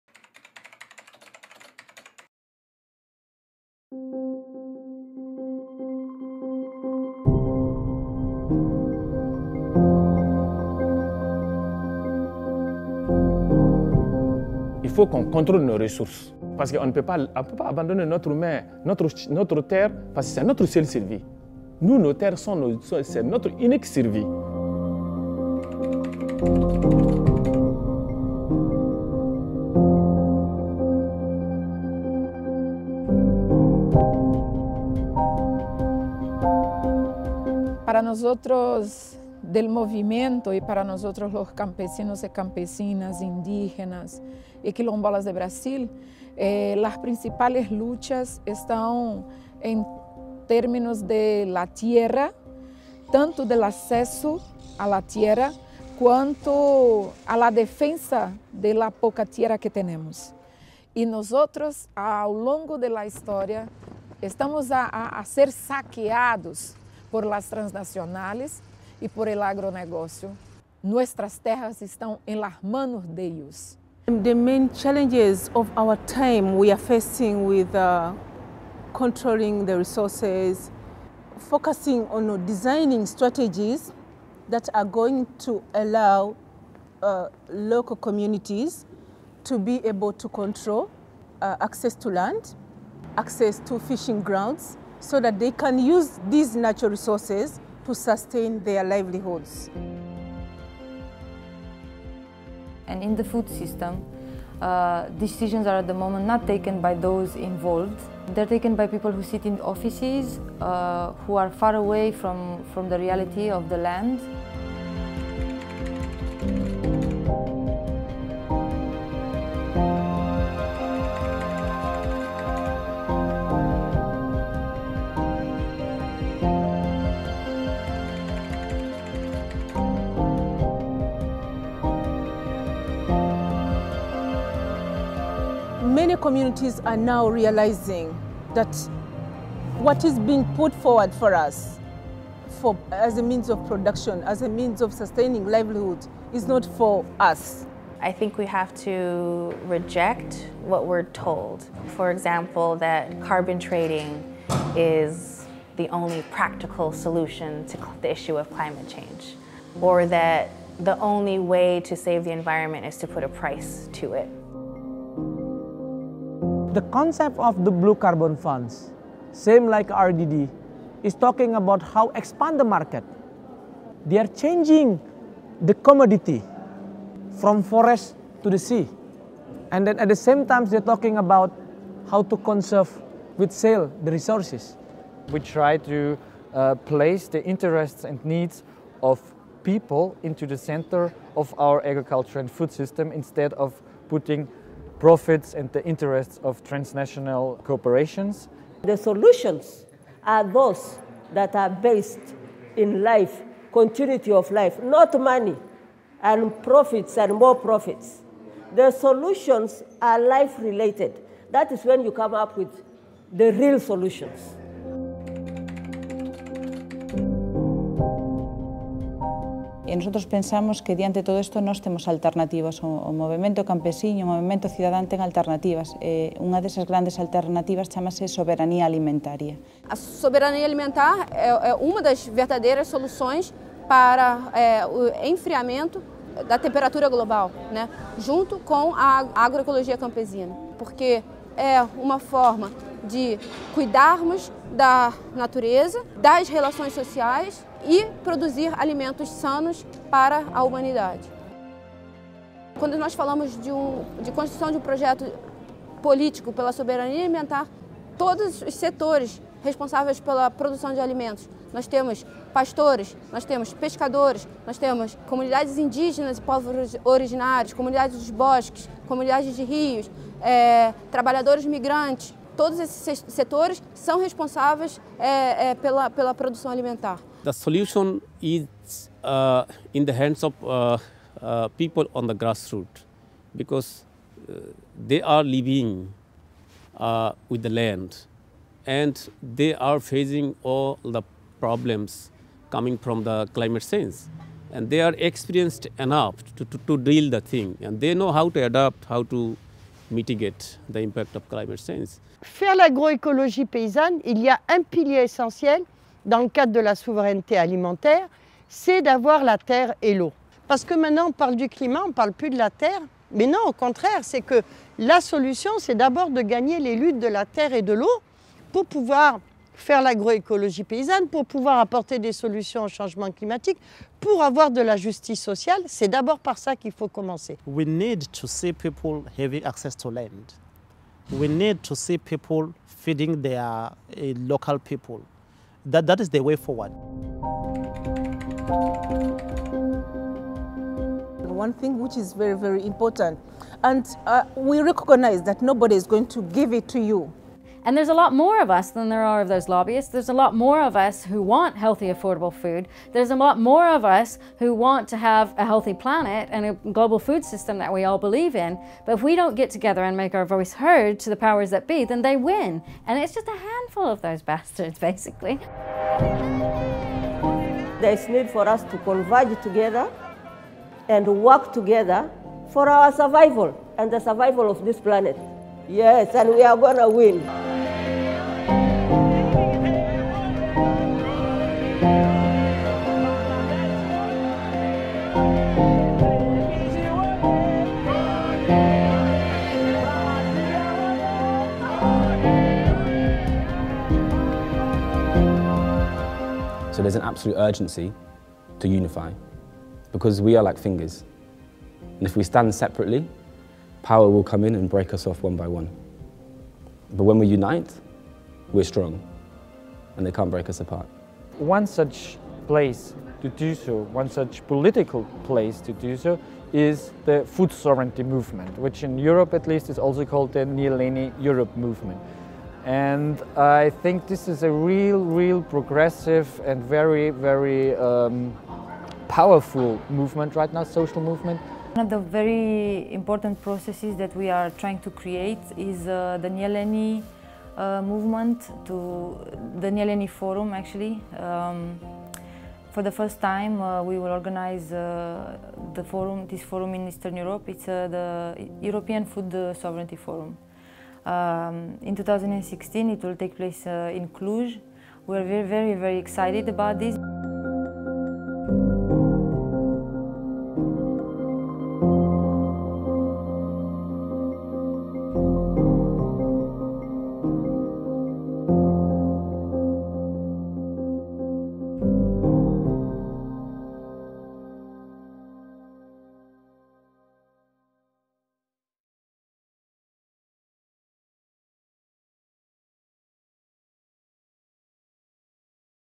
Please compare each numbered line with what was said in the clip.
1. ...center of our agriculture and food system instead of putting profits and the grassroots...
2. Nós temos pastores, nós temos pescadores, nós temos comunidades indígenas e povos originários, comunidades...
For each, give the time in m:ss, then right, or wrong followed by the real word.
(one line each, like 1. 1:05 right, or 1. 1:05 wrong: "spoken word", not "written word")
1. 3:10 wrong: "interests", not "grassroots"
2. 4:21 right.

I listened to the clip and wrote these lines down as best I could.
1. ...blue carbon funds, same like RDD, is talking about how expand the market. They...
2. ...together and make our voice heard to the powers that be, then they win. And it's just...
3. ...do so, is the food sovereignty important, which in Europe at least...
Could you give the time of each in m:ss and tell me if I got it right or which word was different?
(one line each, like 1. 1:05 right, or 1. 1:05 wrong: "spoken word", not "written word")
1. 2:47 right
2. 5:59 right
3. 6:55 wrong: "movement", not "important".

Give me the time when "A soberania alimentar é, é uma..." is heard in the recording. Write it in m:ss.
3:49.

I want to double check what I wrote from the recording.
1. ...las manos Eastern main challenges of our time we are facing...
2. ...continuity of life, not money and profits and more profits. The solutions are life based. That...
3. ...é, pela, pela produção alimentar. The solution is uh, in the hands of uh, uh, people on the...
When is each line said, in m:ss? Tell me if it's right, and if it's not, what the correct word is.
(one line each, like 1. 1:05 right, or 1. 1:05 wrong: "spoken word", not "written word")
1. 1:12 wrong: "The", not "Eastern"
2. 3:23 wrong: "related", not "based"
3. 4:35 right.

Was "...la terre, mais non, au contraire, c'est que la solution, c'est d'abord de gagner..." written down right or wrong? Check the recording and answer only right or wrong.
right.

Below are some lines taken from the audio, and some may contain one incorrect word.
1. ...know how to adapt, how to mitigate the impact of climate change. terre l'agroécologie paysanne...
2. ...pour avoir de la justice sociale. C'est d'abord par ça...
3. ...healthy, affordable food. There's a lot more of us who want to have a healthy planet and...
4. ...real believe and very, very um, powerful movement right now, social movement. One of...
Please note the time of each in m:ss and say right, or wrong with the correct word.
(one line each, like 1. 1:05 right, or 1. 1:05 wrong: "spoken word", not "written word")
1. 4:58 wrong: "faire", not "terre"
2. 5:24 right
3. 5:51 right
4. 7:05 wrong: "progressive", not "believe".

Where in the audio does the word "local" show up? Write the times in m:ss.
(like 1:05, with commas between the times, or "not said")
1:27, 5:34.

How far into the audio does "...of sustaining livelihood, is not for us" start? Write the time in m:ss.
2:24.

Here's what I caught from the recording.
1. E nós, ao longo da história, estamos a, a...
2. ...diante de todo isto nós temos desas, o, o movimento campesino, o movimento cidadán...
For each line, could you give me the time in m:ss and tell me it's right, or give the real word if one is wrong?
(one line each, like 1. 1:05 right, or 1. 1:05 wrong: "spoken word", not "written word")
1. 1:00 right
2. 3:40 wrong: "alternativas", not "desas".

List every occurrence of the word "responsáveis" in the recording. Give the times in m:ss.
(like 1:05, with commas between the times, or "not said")
4:19, 4:34.